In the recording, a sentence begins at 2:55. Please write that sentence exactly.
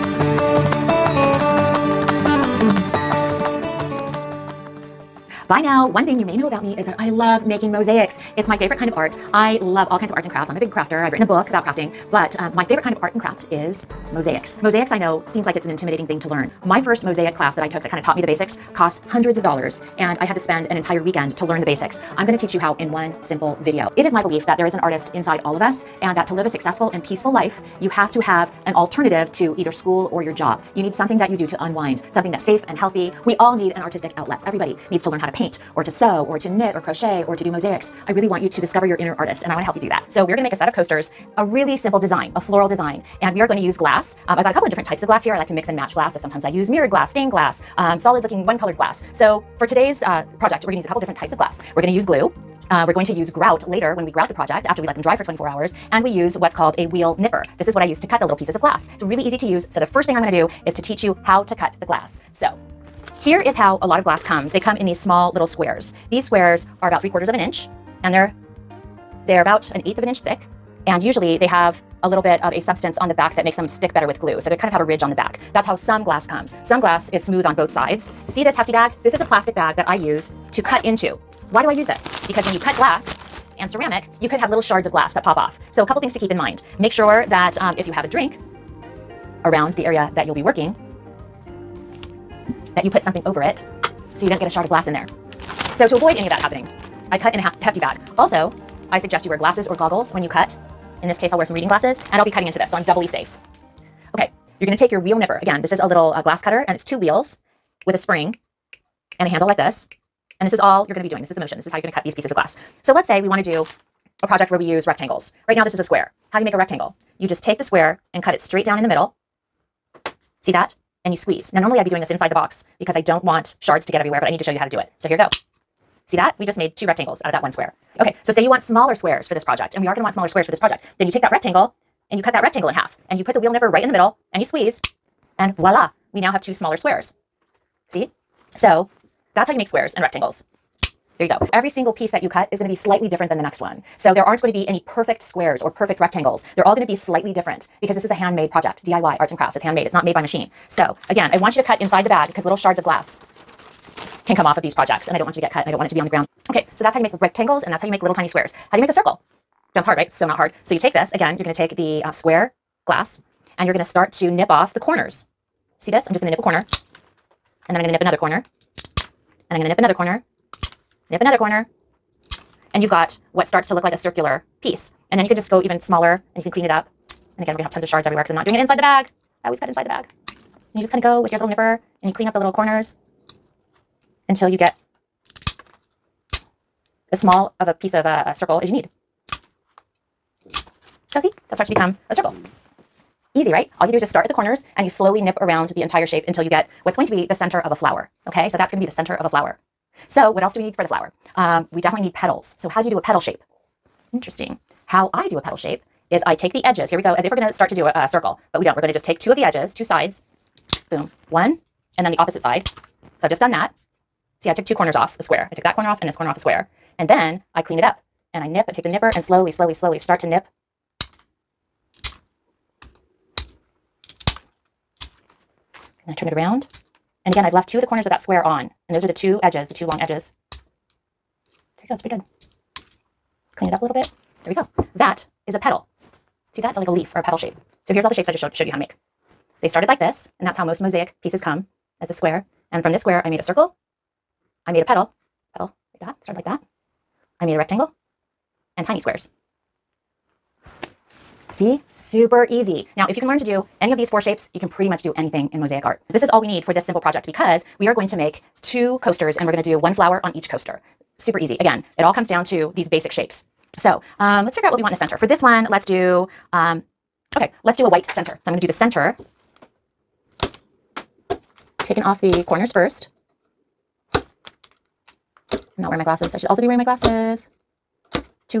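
And then you can just go even smaller and you can clean it up.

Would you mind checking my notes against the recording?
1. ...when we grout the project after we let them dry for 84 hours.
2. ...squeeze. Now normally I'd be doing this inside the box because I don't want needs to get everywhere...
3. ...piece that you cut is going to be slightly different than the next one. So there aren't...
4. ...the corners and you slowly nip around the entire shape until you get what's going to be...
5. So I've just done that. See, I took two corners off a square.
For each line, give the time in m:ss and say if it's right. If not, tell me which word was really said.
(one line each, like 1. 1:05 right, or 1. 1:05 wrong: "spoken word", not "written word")
1. 0:53 wrong: "24", not "84"
2. 2:01 wrong: "shards", not "needs"
3. 2:21 right
4. 3:14 right
5. 3:33 right.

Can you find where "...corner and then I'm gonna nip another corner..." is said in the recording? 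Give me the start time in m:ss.
2:46.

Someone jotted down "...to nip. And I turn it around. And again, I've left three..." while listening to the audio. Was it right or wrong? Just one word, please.
wrong.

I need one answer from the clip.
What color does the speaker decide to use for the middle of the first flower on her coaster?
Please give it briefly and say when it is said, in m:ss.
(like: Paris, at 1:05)
White, at 4:27.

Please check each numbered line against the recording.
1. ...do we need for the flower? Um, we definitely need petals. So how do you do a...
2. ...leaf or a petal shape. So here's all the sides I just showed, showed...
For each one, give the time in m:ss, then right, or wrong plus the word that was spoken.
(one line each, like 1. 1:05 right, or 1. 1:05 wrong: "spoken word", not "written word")
1. 3:20 right
2. 3:56 wrong: "shapes", not "sides".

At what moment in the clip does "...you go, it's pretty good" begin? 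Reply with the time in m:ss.
3:51.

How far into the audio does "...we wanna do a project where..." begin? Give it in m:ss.
1:53.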